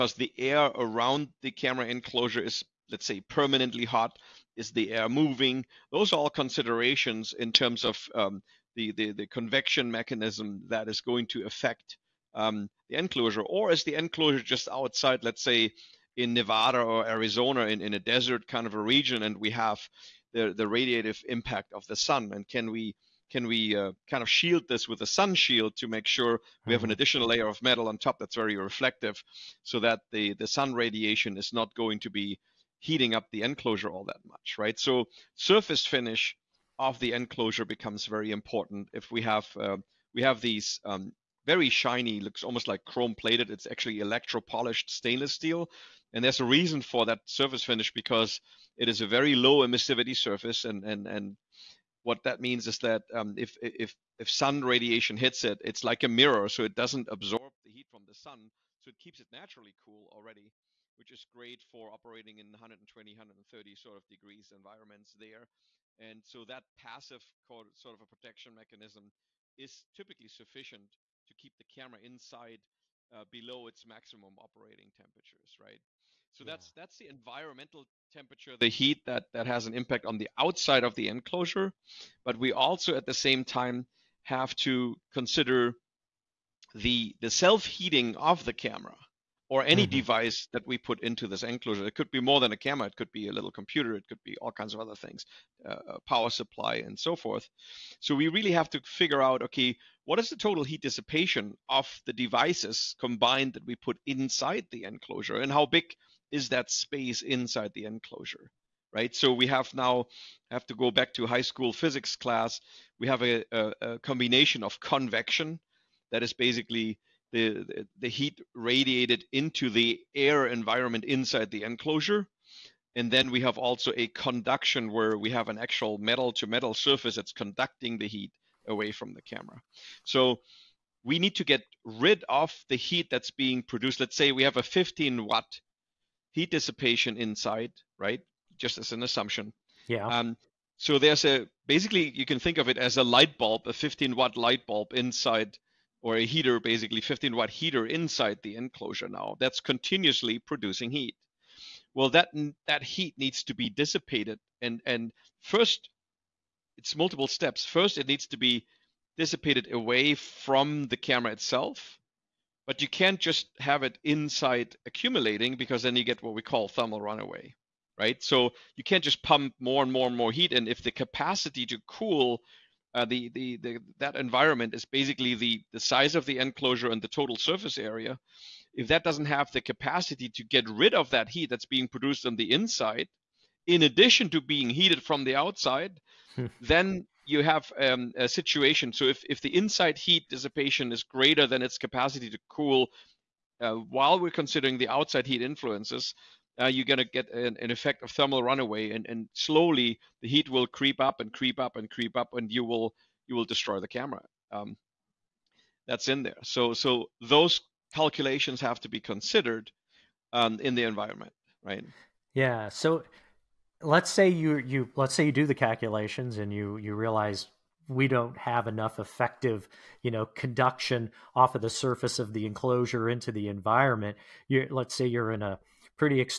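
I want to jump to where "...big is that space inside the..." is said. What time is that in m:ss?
1:45.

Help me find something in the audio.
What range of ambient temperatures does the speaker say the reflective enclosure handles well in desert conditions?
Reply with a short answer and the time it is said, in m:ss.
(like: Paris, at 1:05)
120 to 130 degrees, at 1:02.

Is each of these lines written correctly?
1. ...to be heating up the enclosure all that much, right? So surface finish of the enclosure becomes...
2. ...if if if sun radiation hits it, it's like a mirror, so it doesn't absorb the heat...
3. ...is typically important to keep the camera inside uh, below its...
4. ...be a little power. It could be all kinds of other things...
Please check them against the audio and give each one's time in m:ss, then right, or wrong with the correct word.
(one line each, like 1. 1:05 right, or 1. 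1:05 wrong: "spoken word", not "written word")
1. 0:31 right
2. 0:53 right
3. 1:09 wrong: "sufficient", not "important"
4. 1:33 wrong: "computer", not "power".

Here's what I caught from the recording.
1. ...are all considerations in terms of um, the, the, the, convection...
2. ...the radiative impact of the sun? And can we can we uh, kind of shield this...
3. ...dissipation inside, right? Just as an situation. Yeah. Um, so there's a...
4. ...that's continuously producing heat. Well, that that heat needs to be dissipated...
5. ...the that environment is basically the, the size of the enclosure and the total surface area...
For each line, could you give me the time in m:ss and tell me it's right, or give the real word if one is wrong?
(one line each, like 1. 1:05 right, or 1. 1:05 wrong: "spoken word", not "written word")
1. 0:06 right
2. 0:20 right
3. 2:16 wrong: "assumption", not "situation"
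4. 2:29 right
5. 2:53 right.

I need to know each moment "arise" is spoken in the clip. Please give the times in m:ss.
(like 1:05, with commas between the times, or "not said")
not said.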